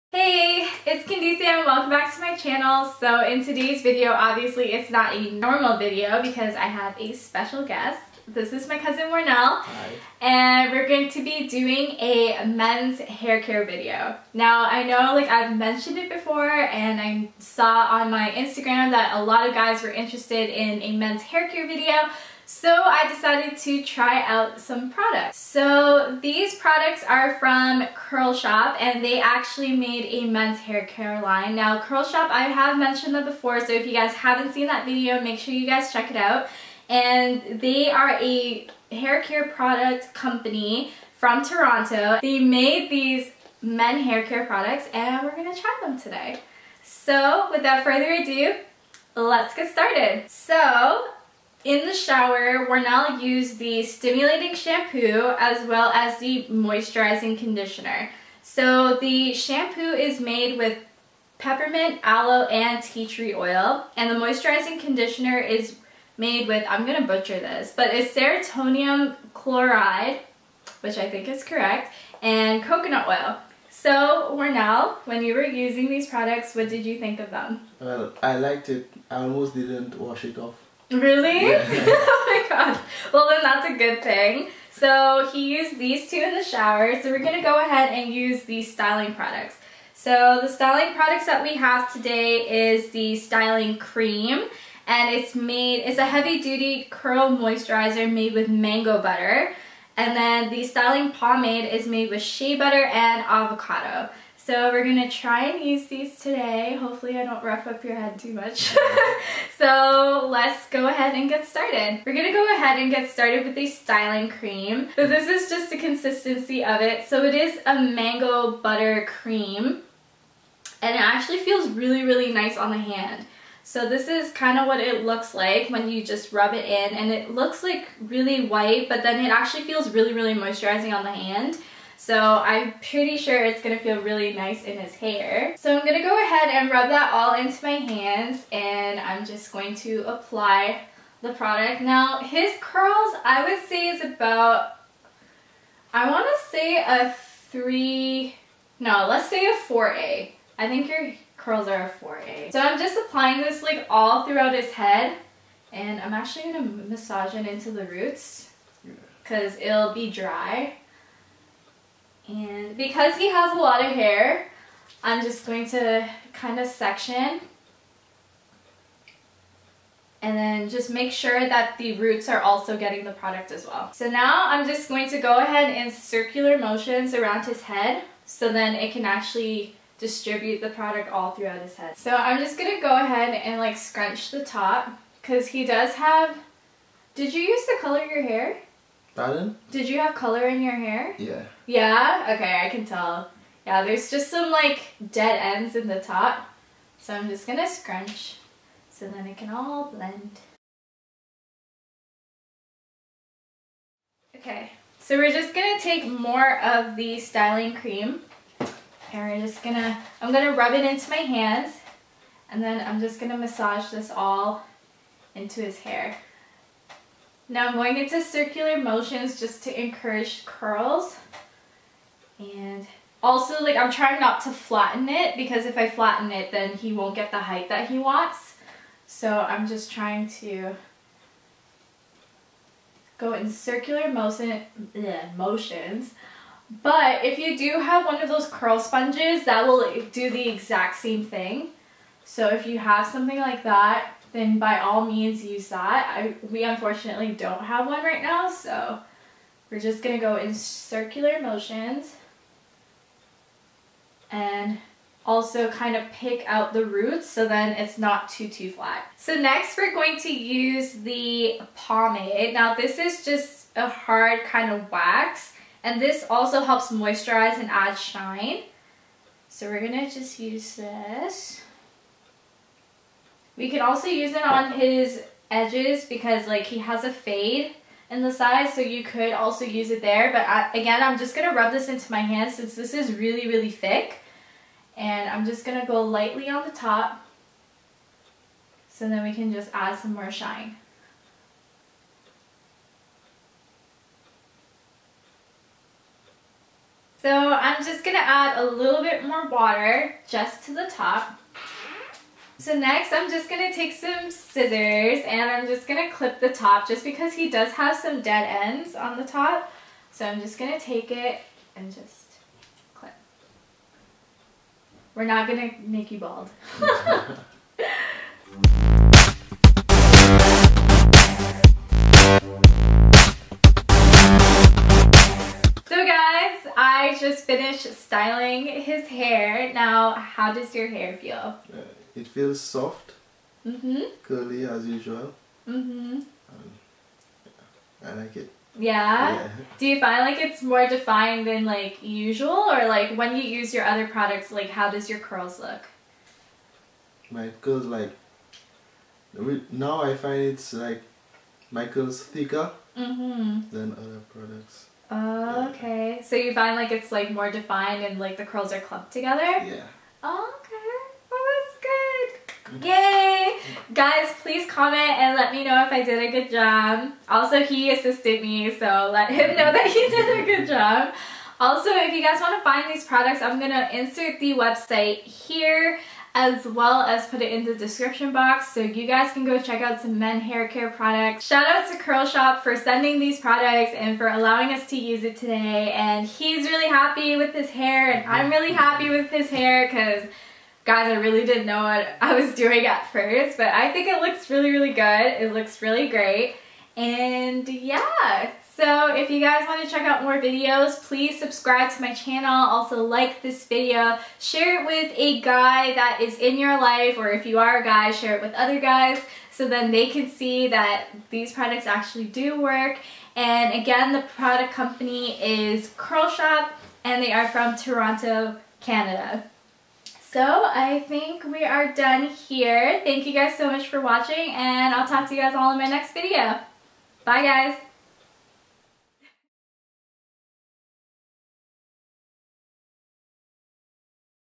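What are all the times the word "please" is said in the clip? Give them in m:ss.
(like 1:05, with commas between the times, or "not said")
6:04, 6:41.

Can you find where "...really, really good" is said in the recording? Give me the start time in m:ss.
6:34.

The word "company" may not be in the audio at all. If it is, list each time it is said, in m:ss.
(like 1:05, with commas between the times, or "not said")
0:40, 6:54.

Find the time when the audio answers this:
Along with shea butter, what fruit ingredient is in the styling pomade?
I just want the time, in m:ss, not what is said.
1:43.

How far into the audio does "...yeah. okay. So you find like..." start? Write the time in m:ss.
5:55.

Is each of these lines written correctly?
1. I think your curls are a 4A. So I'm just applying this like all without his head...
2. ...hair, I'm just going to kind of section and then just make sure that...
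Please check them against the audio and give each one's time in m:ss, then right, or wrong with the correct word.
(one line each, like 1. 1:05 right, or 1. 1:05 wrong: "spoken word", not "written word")
1. 2:30 wrong: "throughout", not "without"
2. 2:43 right.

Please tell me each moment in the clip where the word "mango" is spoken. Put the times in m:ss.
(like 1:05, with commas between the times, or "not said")
1:38, 1:57.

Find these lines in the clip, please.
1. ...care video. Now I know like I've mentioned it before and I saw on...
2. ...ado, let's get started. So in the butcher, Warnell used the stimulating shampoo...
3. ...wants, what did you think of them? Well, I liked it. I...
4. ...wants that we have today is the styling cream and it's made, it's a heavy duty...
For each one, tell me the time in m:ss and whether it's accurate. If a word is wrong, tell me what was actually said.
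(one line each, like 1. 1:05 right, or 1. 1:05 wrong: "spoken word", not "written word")
1. 0:13 right
2. 0:48 wrong: "shower", not "butcher"
3. 1:16 wrong: "products", not "wants"
4. 1:30 wrong: "products", not "wants".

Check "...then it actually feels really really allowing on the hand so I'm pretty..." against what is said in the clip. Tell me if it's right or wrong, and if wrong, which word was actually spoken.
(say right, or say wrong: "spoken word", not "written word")
wrong: "moisturizing", not "allowing".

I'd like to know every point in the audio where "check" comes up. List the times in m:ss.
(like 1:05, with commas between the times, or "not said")
0:35, 6:19, 6:39.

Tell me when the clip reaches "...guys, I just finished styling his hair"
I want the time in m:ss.
5:26.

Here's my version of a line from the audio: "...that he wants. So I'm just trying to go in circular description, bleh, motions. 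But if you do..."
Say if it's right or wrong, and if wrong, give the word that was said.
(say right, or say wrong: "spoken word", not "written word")
wrong: "motion", not "description".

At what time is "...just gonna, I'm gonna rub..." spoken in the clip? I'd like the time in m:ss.
3:29.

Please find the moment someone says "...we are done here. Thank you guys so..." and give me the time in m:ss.
7:01.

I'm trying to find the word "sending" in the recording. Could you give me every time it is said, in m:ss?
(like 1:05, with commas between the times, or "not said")
6:22.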